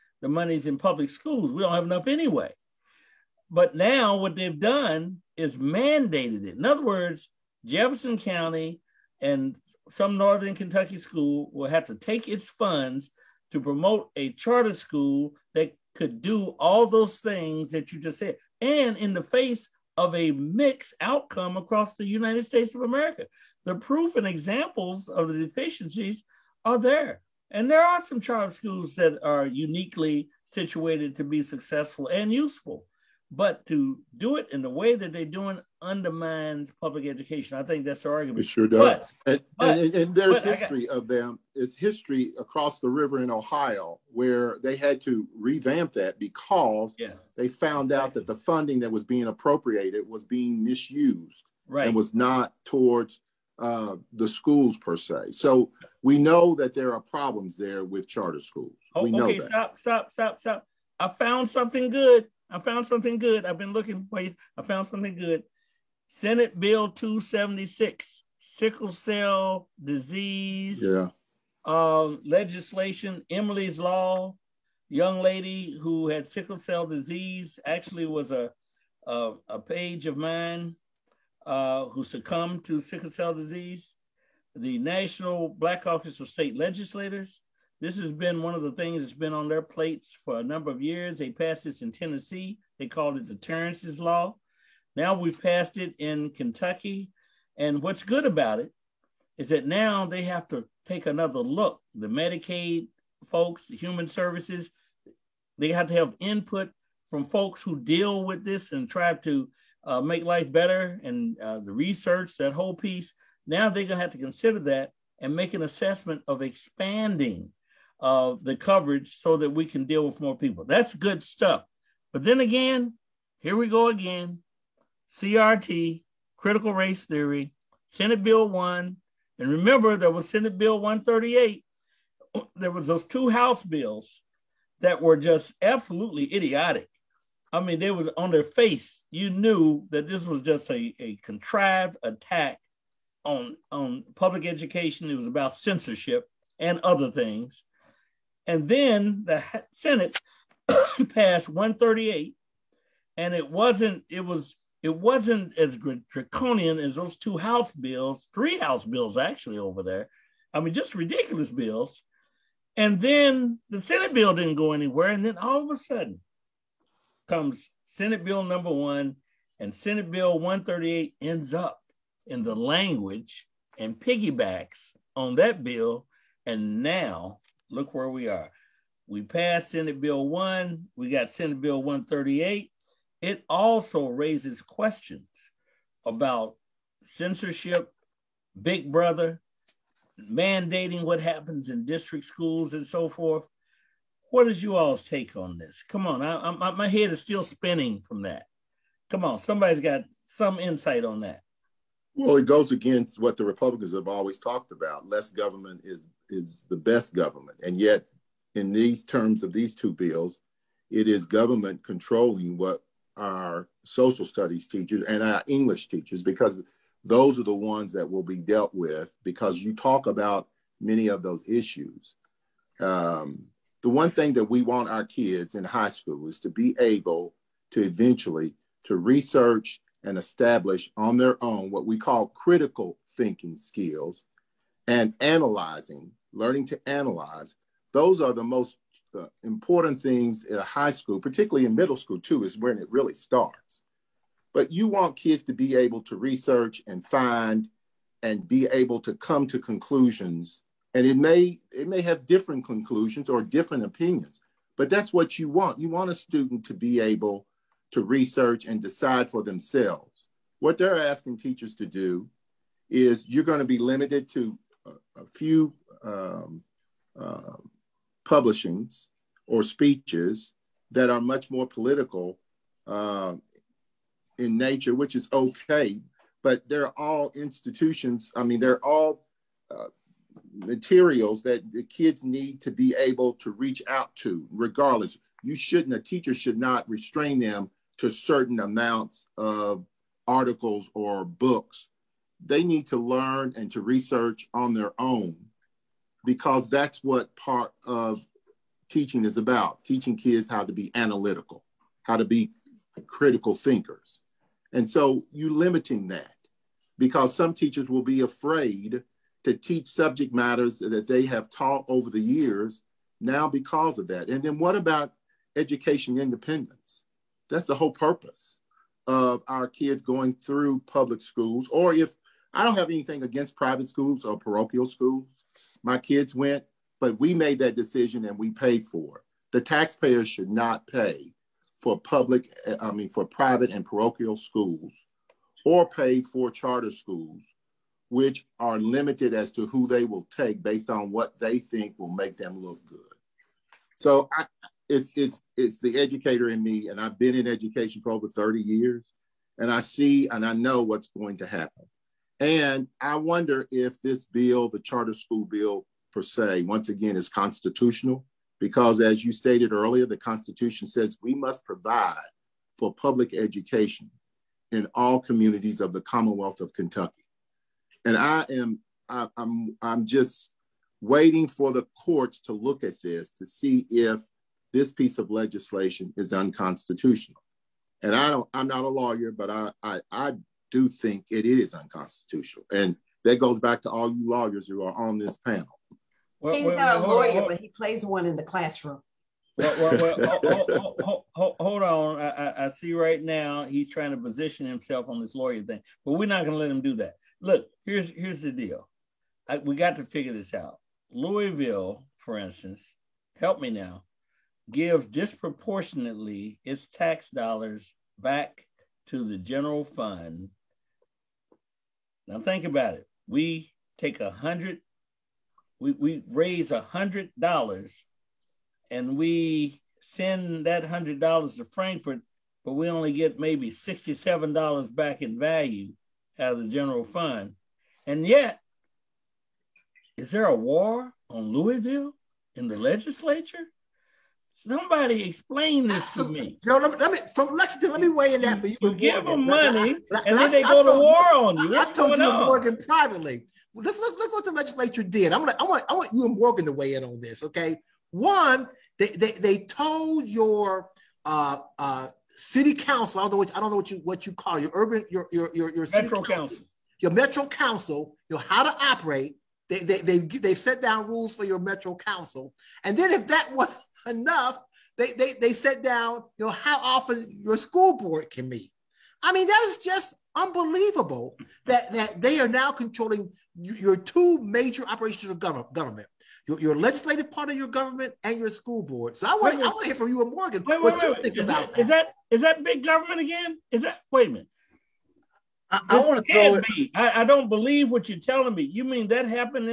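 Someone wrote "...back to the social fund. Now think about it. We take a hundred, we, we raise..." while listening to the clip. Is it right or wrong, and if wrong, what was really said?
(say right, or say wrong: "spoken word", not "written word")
wrong: "general", not "social".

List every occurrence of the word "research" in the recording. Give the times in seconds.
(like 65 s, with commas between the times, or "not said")
111 s, 228 s, 246 s, 258 s, 293 s.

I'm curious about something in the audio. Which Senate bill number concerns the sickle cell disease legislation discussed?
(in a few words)
276.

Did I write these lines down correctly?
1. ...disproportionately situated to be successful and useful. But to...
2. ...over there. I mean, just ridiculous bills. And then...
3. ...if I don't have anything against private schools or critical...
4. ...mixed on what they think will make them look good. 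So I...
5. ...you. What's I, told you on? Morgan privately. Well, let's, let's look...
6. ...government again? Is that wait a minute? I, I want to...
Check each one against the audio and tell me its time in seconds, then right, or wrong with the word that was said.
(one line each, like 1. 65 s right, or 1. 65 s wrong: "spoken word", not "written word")
1. 29 s wrong: "uniquely", not "disproportionately"
2. 159 s right
3. 321 s wrong: "parochial", not "critical"
4. 340 s wrong: "based", not "mixed"
5. 441 s right
6. 482 s right.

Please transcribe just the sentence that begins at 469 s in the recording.
I mean that is just unbelievable that that they are now controlling your two major operations of government.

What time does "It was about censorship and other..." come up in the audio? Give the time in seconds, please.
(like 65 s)
145 s.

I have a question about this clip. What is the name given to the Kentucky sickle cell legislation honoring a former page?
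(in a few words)
Emily's Law.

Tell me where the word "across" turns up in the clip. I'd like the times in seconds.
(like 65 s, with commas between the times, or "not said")
21 s, 42 s.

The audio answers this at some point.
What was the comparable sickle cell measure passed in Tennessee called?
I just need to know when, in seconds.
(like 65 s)
93 s.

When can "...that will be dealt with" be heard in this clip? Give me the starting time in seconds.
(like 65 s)
217 s.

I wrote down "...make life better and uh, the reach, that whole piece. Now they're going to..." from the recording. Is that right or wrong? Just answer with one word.
wrong.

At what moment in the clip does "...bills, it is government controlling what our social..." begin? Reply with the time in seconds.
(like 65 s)
209 s.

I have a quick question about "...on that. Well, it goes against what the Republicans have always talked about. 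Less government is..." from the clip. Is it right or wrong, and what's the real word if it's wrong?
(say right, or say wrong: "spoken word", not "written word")
right.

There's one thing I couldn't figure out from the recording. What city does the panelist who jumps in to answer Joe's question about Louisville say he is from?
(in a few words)
Lexington.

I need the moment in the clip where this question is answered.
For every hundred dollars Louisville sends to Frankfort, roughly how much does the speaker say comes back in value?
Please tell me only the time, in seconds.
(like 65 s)
423 s.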